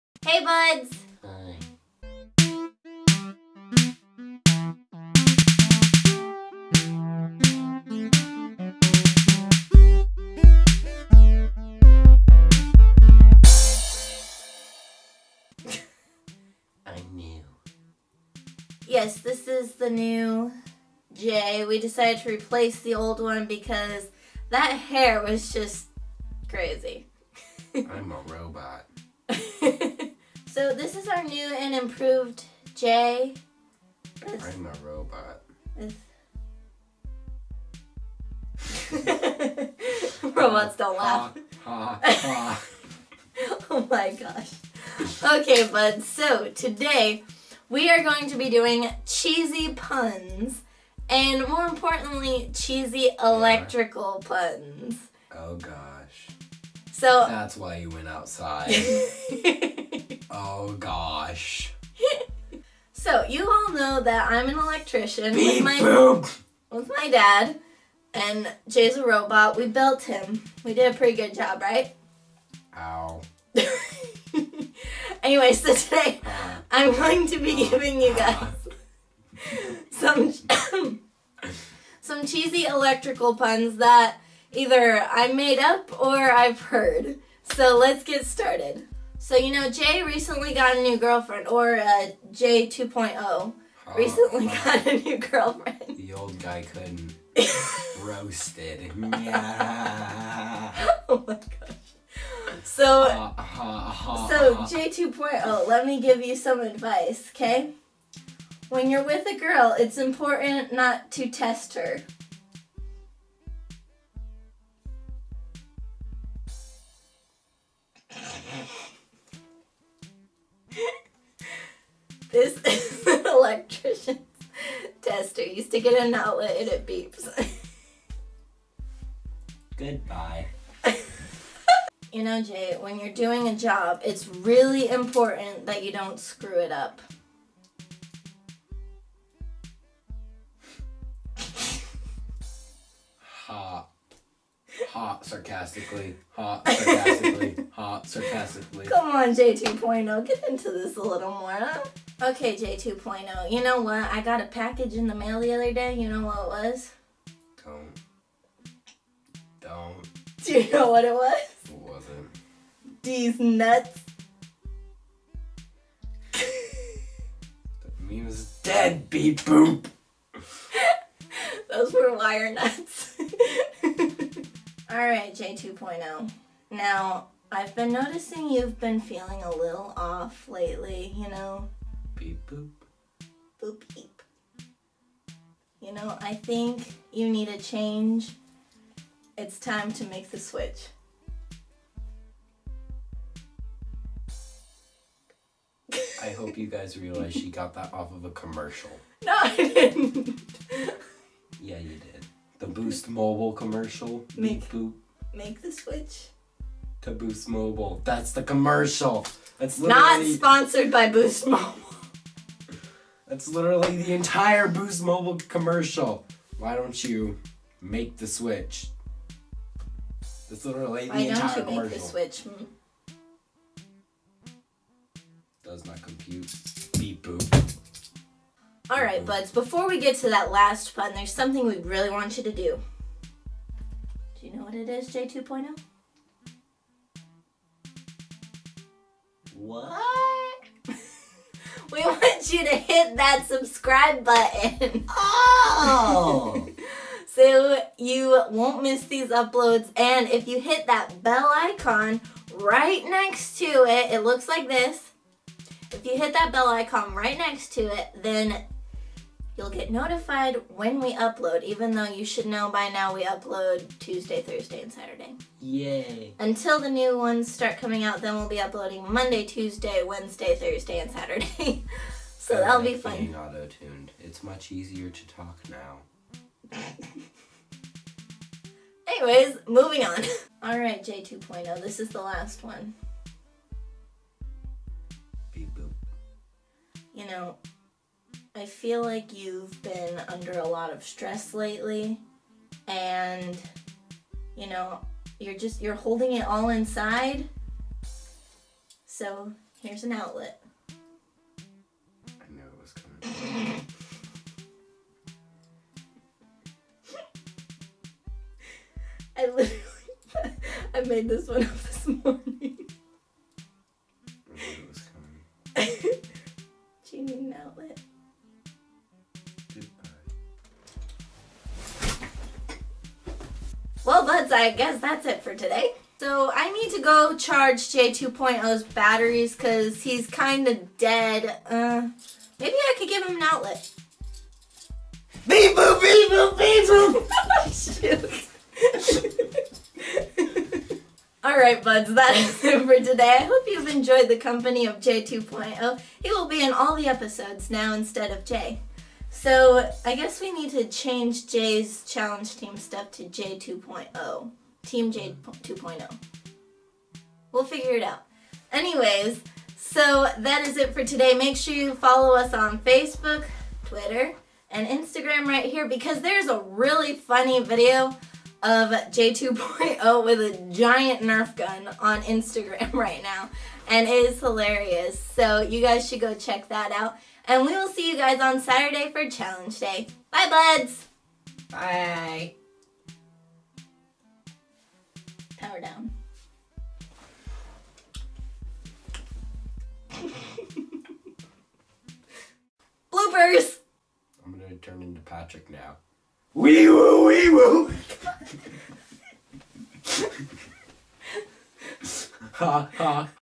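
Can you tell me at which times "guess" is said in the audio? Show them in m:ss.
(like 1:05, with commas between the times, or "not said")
5:24, 5:50.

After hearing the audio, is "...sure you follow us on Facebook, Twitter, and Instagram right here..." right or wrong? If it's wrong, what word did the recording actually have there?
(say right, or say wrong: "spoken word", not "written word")
right.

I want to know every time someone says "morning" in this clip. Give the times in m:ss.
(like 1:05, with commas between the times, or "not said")
5:12.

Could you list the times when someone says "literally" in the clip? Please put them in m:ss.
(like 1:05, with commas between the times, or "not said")
3:33, 3:40, 5:09.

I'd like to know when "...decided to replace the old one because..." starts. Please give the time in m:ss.
0:21.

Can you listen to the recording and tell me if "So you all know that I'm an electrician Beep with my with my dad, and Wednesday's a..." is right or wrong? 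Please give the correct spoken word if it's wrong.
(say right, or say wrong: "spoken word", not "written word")
wrong: "Jay", not "Wednesday".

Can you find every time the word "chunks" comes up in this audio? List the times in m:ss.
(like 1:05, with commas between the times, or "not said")
not said.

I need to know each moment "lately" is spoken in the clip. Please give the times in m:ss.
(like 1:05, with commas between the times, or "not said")
3:00, 4:51.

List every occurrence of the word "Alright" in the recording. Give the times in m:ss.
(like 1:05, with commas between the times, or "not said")
2:54, 4:40, 5:41.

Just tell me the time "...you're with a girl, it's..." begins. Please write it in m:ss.
1:48.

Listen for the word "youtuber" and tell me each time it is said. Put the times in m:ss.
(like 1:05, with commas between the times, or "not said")
not said.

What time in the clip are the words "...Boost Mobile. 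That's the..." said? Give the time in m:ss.
3:27.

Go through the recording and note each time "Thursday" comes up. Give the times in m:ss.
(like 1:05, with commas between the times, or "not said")
4:24, 4:30.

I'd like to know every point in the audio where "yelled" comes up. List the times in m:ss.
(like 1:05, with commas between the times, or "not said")
not said.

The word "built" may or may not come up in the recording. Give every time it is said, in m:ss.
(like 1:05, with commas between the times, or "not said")
1:09.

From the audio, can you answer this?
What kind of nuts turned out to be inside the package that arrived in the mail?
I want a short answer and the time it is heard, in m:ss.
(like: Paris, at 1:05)
wire nuts, at 2:52.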